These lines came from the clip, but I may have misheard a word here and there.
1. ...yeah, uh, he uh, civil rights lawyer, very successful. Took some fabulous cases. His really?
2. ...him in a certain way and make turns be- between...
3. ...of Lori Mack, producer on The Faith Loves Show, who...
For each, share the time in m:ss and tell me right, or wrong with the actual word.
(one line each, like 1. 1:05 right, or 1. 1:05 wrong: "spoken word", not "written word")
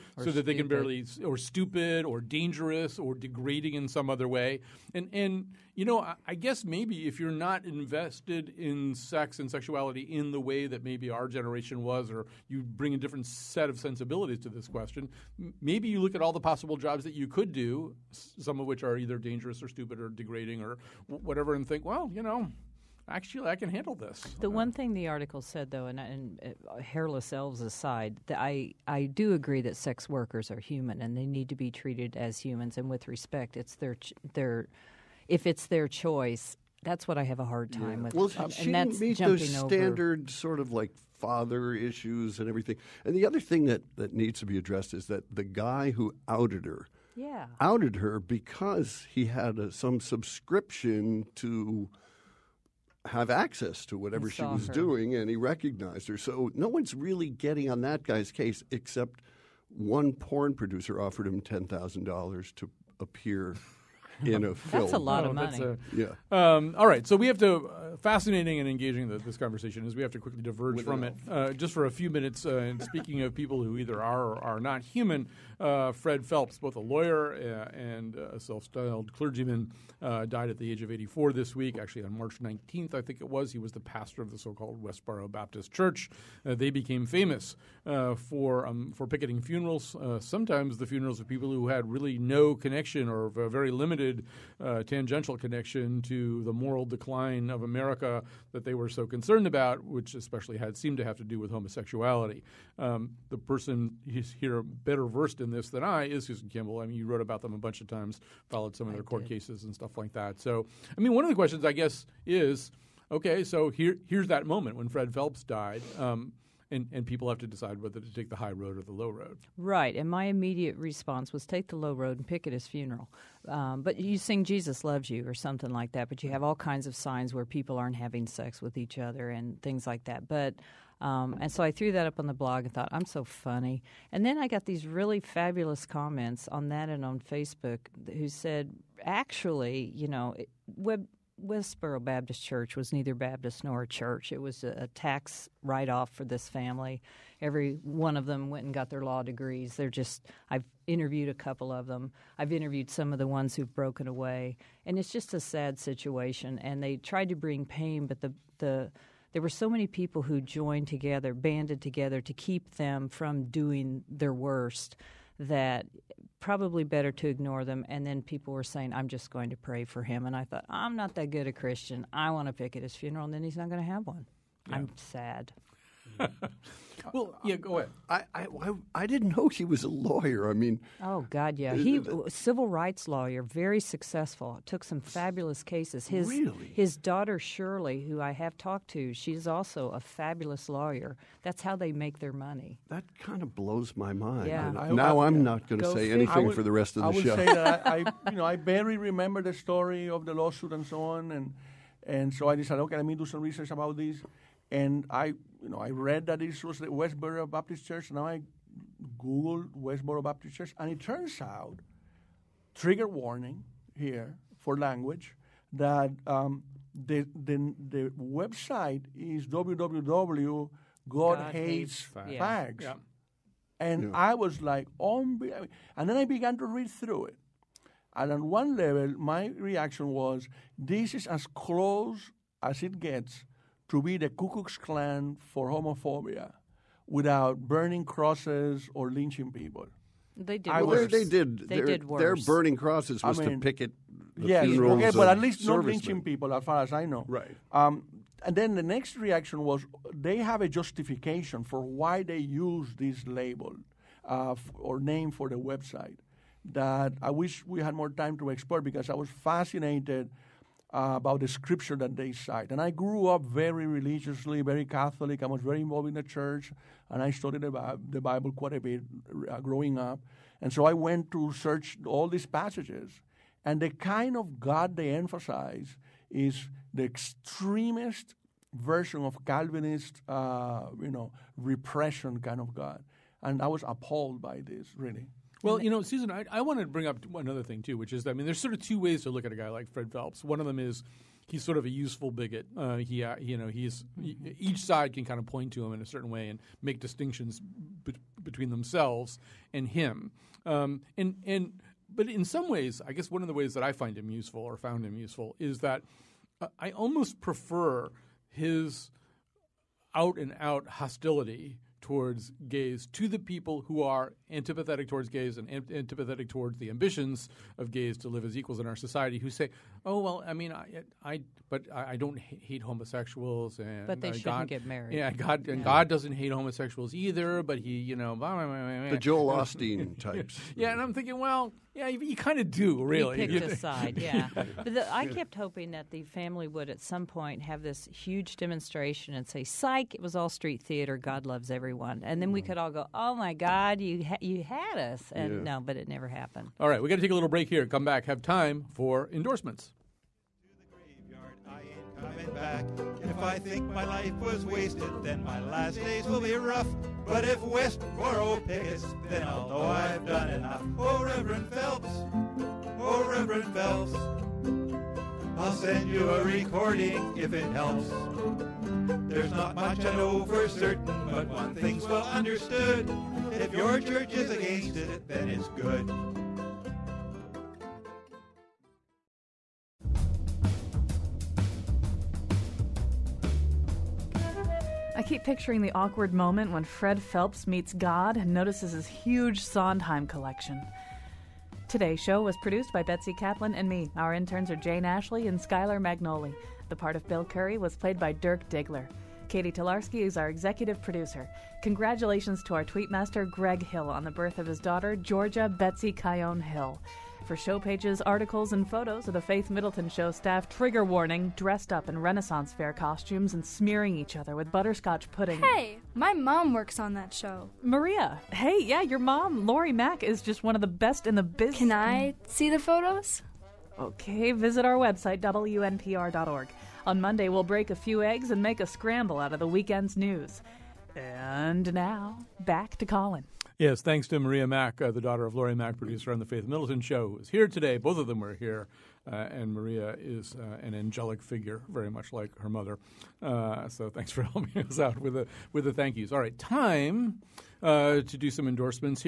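1. 3:01 right
2. 4:55 wrong: "distinctions", not "turns"
3. 7:15 wrong: "Middleton", not "Loves".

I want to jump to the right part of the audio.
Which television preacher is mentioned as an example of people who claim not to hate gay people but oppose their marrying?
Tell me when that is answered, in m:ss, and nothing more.
5:29.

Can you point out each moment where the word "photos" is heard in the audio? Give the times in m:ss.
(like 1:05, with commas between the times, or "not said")
6:48, 7:02.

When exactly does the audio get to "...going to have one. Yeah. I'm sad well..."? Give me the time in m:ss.
2:53.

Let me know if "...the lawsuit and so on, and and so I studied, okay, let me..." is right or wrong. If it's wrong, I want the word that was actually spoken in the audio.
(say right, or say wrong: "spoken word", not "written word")
wrong: "decided", not "studied".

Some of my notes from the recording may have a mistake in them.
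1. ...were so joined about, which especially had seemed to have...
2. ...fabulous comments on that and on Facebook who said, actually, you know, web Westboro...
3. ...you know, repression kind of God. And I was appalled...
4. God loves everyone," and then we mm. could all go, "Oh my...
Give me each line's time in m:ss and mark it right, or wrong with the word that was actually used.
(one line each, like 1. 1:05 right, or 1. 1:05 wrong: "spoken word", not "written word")
1. 1:38 wrong: "concerned", not "joined"
2. 2:15 right
3. 4:40 right
4. 5:41 right.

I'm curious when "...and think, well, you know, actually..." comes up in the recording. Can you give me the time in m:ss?
0:21.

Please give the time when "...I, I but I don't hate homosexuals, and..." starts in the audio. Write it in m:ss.
5:20.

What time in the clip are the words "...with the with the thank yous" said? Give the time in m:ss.
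7:25.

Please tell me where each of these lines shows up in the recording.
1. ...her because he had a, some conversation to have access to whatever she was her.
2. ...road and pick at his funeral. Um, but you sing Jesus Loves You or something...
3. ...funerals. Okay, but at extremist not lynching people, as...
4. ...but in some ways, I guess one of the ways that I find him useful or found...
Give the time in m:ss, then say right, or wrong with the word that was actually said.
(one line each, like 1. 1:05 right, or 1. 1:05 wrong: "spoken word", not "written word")
1. 0:47 wrong: "subscription", not "conversation"
2. 2:01 right
3. 4:04 wrong: "least", not "extremist"
4. 5:02 right.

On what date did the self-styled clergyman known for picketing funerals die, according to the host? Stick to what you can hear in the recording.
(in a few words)
March 19th.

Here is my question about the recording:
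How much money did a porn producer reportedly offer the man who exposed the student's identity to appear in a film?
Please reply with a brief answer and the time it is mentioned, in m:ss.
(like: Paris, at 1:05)
$10,000, at 1:01.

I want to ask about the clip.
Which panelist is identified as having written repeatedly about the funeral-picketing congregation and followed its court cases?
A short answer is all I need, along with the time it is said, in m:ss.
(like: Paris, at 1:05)
Susan Campbell, at 1:46.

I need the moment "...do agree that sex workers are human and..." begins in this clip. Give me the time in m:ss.
0:29.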